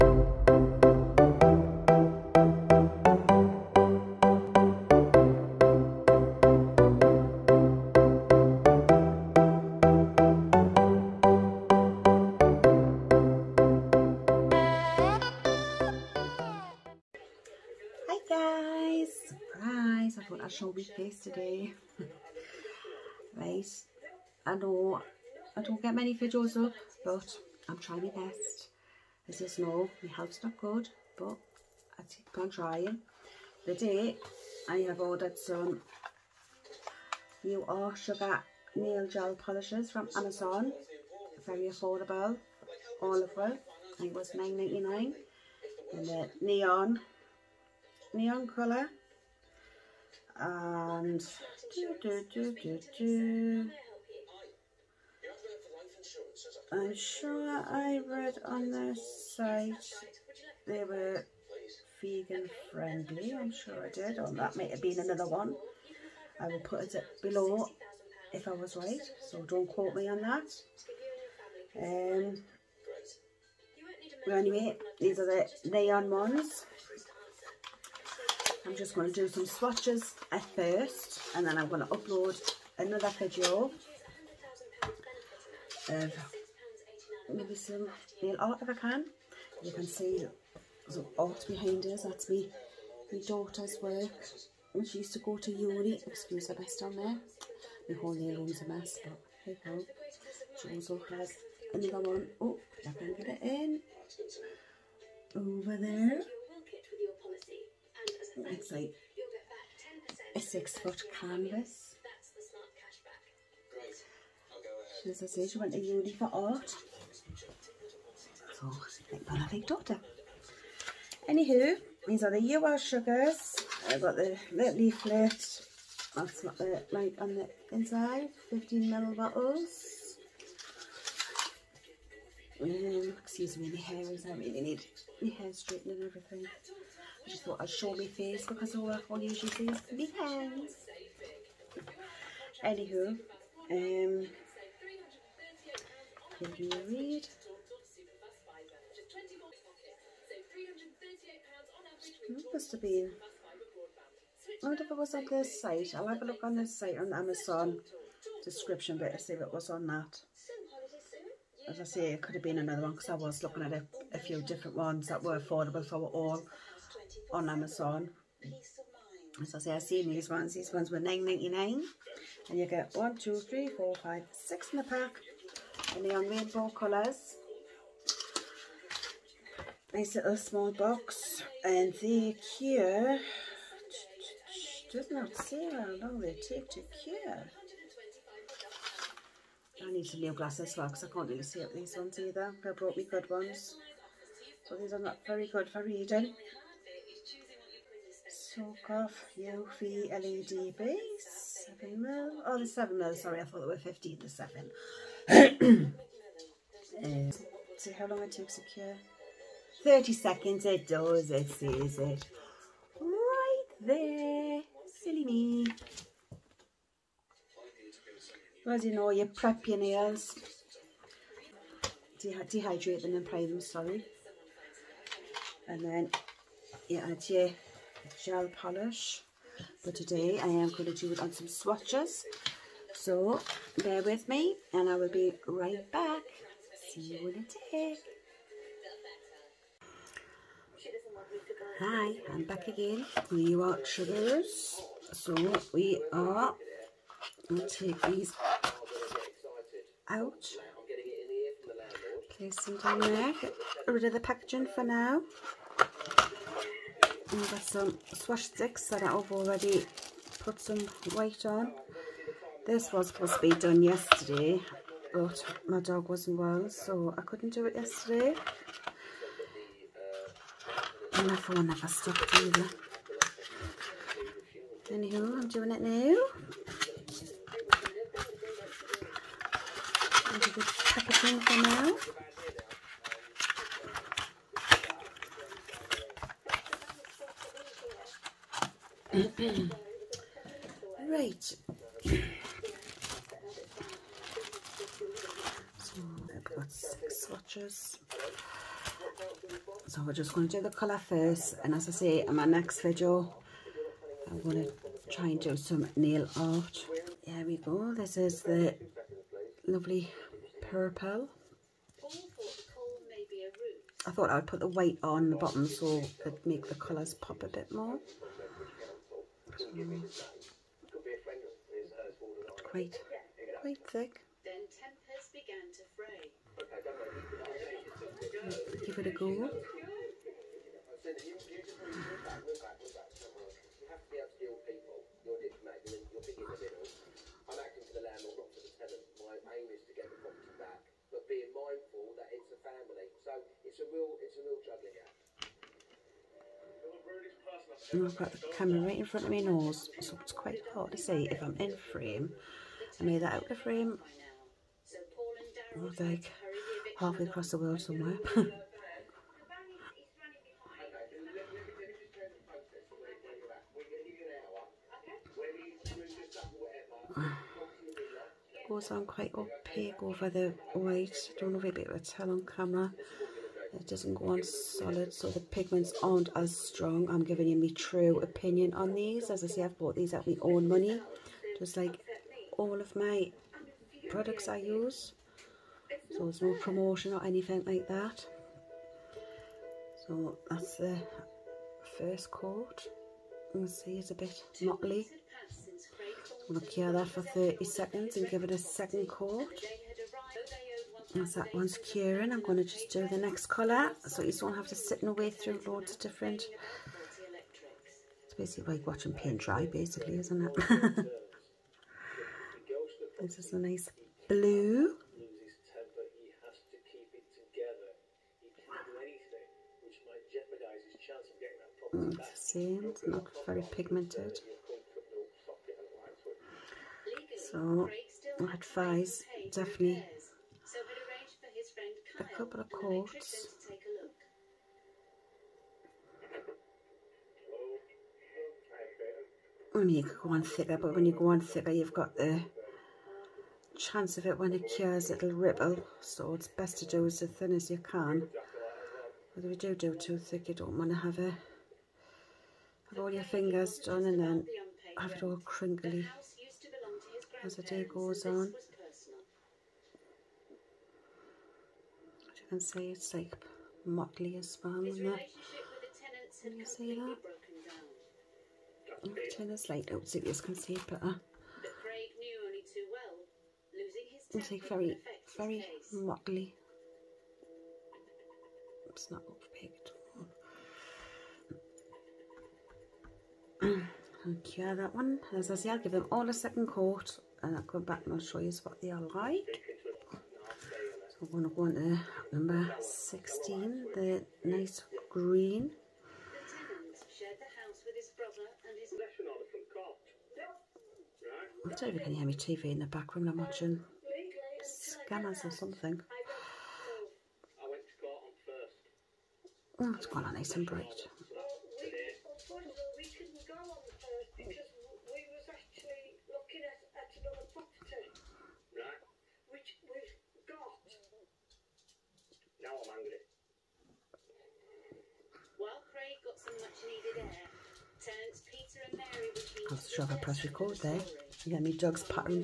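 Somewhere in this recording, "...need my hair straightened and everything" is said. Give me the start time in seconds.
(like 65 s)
134 s.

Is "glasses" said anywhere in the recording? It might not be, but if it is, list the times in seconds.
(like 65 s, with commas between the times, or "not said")
190 s.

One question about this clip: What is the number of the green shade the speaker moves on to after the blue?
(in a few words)
16.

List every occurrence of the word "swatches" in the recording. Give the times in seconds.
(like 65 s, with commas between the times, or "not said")
79 s, 231 s, 297 s.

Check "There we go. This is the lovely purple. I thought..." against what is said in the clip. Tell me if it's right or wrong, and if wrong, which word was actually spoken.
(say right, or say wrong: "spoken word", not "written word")
right.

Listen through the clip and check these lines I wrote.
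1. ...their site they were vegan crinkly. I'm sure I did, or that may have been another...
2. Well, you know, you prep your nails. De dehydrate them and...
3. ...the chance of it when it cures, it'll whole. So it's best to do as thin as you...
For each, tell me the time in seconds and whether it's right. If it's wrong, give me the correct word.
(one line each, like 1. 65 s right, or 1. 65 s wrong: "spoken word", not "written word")
1. 58 s wrong: "friendly", not "crinkly"
2. 218 s right
3. 442 s wrong: "ripple", not "whole".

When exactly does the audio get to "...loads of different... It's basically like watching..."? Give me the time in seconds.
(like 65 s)
405 s.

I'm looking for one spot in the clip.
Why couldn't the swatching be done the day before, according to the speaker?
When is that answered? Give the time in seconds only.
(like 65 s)
265 s.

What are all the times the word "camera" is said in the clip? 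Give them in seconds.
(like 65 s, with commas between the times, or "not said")
348 s, 372 s.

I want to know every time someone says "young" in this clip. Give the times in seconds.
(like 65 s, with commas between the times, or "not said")
not said.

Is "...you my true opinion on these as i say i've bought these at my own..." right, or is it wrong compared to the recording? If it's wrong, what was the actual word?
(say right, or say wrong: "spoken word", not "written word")
right.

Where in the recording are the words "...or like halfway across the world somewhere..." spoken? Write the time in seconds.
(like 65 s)
355 s.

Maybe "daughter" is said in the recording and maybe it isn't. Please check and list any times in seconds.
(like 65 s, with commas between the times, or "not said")
93 s, 119 s.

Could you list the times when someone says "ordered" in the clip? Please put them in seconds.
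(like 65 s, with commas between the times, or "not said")
34 s.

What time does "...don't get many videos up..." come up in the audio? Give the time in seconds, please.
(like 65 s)
25 s.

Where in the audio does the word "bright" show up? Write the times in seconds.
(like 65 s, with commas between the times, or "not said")
510 s.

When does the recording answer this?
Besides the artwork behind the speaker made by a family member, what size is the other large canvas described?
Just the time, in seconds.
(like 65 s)
110 s.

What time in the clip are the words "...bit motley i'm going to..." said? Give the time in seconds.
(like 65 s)
394 s.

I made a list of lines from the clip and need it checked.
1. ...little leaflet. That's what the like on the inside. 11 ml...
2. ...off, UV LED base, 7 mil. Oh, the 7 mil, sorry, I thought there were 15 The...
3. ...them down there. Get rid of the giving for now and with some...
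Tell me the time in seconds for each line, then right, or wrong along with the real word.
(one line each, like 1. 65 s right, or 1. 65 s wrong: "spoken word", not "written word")
1. 124 s wrong: "15", not "11"
2. 198 s right
3. 252 s wrong: "packaging", not "giving".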